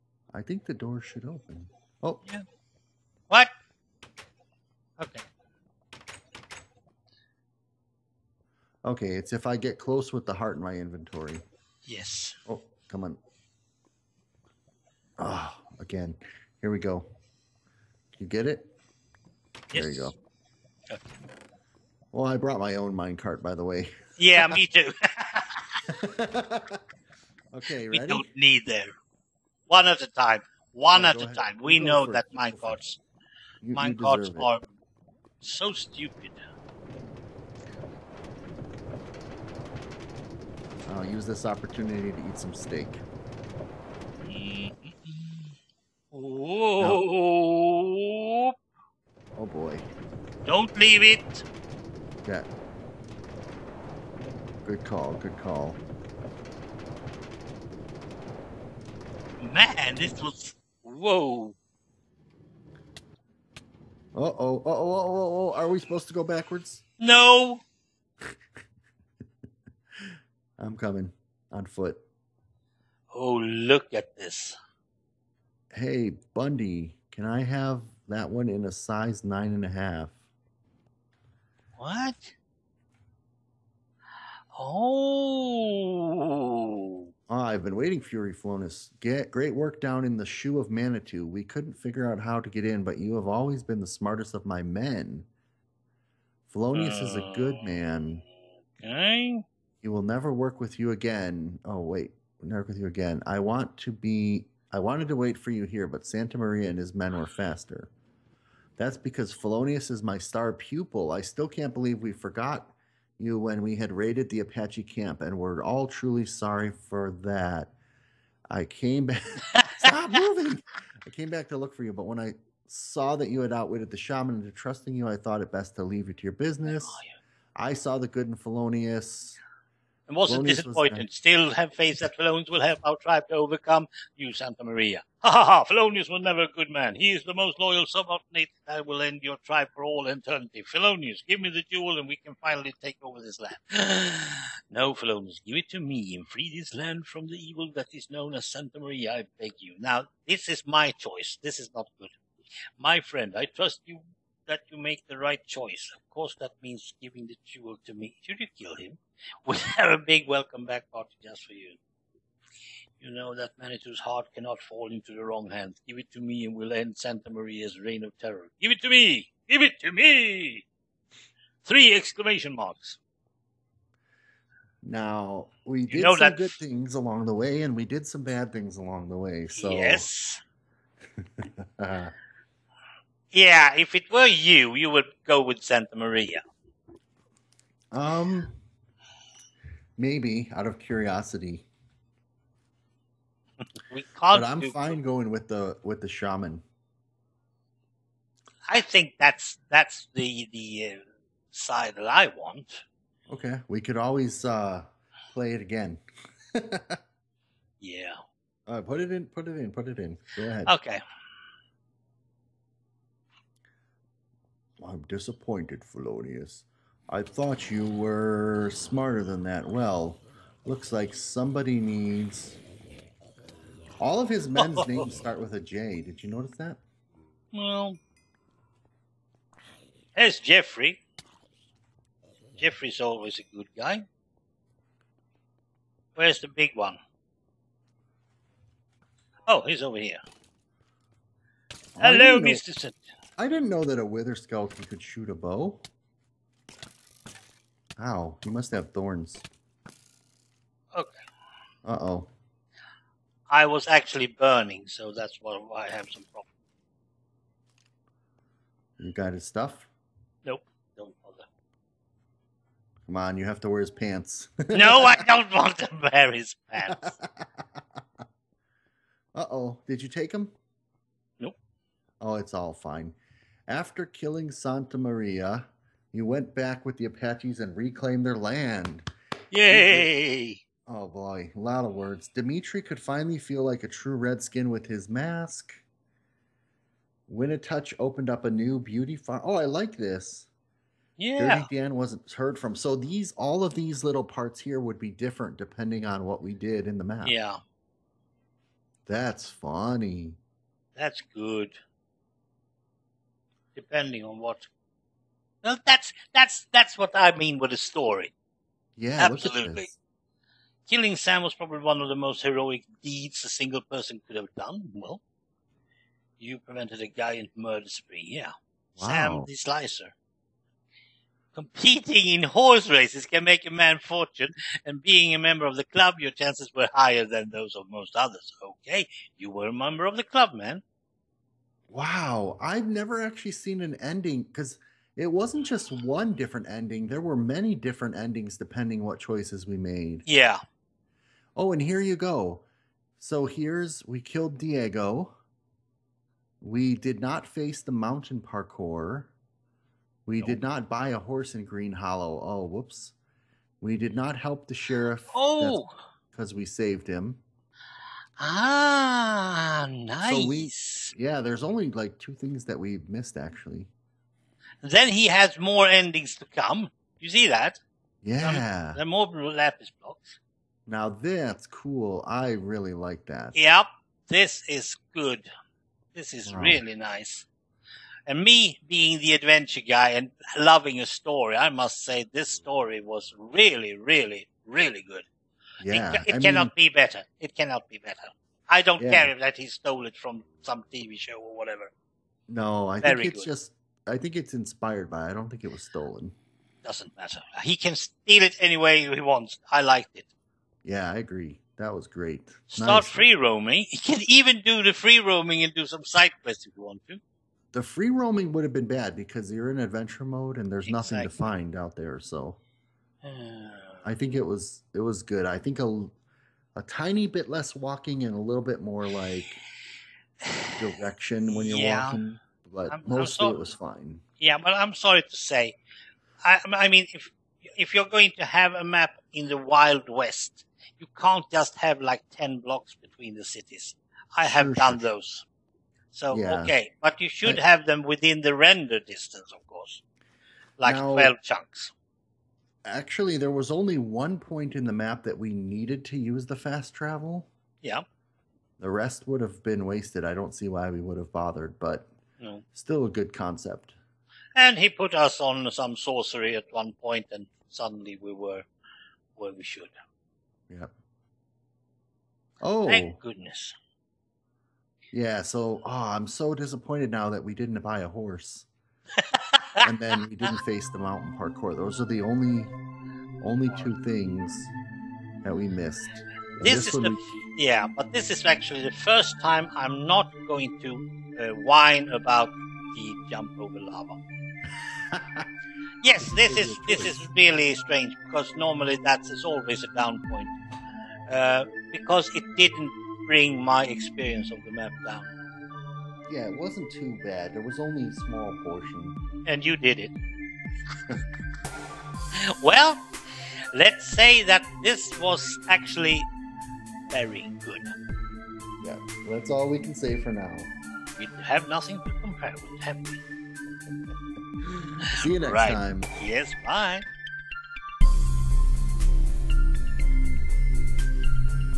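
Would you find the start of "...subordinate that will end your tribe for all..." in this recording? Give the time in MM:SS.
02:17.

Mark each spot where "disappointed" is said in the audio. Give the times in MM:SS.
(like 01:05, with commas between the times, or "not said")
02:10, 03:35, 07:46.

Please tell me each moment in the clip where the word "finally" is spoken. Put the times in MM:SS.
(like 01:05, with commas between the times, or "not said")
02:22, 04:42.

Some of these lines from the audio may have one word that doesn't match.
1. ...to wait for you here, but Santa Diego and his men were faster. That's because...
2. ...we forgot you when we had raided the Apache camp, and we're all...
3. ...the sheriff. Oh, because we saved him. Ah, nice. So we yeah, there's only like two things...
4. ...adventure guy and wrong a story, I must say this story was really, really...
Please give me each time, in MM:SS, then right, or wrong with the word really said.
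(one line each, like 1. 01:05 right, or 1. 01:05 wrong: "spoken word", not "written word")
1. 01:45 wrong: "Maria", not "Diego"
2. 01:51 right
3. 05:54 right
4. 06:19 wrong: "loving", not "wrong".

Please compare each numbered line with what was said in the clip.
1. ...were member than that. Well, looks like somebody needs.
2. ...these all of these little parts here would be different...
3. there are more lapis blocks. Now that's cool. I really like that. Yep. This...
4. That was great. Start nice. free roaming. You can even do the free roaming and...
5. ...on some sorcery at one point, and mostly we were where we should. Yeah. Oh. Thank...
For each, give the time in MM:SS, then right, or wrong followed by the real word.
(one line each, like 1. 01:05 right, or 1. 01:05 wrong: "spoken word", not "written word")
1. 03:37 wrong: "smarter", not "member"
2. 04:52 right
3. 06:08 right
4. 06:41 right
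5. 07:35 wrong: "suddenly", not "mostly".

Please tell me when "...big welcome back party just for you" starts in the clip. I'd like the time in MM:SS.
02:39.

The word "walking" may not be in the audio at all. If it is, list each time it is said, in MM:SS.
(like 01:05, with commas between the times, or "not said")
06:57, 07:02.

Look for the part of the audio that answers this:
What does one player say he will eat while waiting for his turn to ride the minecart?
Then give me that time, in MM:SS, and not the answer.
00:42.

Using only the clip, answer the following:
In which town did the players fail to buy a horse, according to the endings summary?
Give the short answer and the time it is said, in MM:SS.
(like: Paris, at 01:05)
Green Hollow, at 05:51.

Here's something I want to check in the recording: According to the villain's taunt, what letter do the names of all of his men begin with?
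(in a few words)
J.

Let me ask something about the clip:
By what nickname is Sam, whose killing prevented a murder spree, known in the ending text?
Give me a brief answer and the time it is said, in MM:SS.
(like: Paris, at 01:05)
Sam the Slicer, at 05:19.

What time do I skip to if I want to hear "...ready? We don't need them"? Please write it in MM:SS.
00:27.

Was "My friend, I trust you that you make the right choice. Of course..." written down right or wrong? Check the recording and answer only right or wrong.
right.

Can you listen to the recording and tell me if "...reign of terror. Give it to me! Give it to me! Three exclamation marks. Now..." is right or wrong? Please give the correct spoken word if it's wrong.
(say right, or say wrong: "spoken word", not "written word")
right.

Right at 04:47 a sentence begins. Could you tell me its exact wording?
Winnetouch opened up a new beauty farm.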